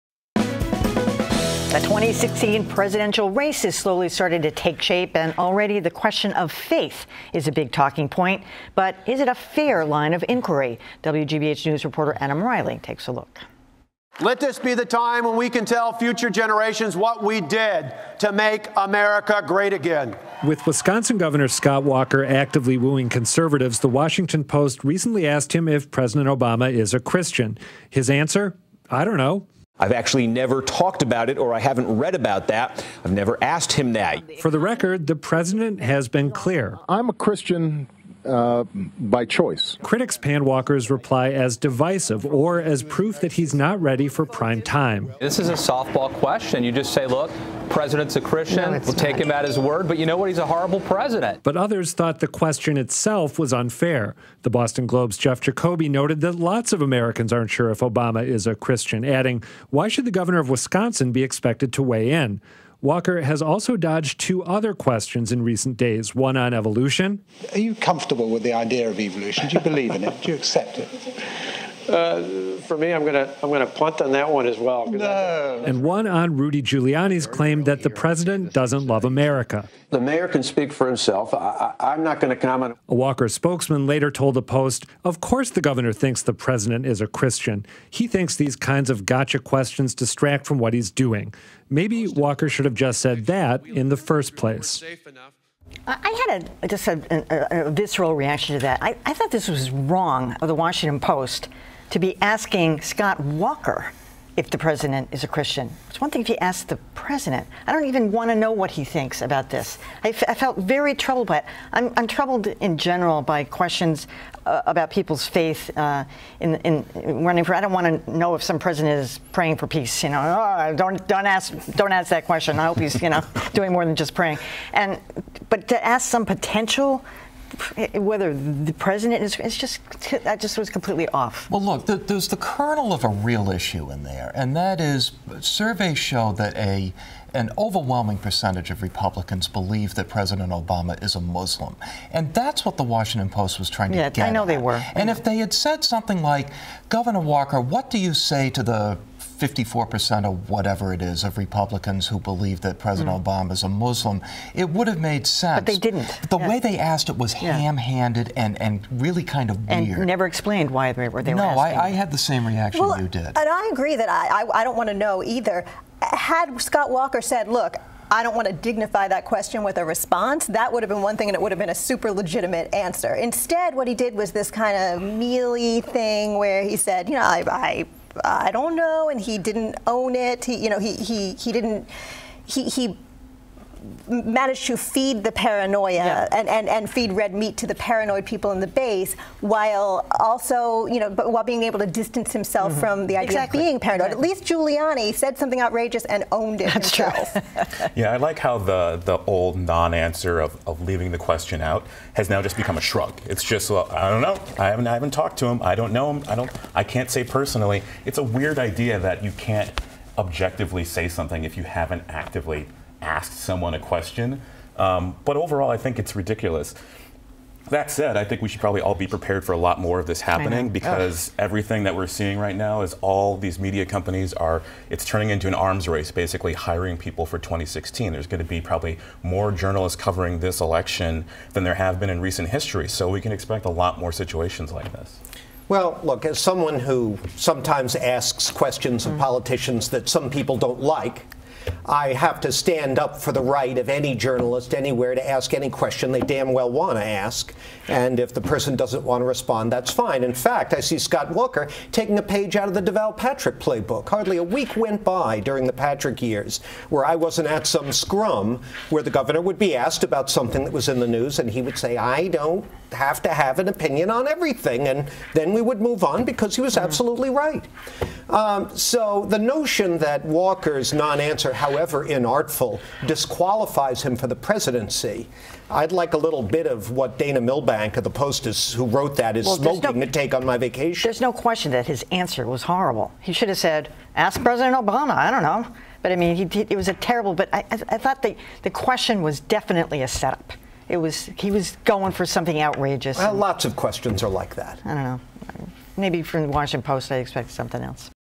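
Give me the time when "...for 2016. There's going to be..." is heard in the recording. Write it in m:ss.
3:47.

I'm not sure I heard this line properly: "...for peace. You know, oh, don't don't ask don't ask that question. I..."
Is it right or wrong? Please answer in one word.
right.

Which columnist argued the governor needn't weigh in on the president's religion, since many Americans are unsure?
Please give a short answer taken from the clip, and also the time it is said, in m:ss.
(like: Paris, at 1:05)
Jeff Jacoby, at 0:55.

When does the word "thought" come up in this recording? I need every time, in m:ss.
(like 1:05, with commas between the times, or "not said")
0:51, 1:39, 4:47.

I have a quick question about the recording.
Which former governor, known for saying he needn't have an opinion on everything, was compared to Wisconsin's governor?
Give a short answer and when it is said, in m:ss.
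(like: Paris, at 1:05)
Deval Patrick, at 4:12.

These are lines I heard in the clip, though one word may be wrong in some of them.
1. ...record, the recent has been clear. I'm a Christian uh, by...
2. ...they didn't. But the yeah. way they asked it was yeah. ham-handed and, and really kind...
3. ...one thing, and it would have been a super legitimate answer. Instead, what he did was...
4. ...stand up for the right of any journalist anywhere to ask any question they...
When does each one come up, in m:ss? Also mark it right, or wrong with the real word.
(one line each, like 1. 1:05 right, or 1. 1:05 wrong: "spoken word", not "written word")
1. 0:34 wrong: "president", not "recent"
2. 2:35 right
3. 2:51 right
4. 4:02 right.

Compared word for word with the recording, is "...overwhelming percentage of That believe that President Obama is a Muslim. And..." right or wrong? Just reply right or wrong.
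wrong.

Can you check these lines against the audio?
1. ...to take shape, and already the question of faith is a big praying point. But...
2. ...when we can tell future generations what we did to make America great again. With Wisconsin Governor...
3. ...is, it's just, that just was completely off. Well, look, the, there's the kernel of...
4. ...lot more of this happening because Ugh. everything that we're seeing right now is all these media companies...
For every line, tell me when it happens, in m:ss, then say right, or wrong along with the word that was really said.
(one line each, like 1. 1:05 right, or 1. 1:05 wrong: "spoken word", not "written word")
1. 0:04 wrong: "talking", not "praying"
2. 0:15 right
3. 2:09 right
4. 3:39 right.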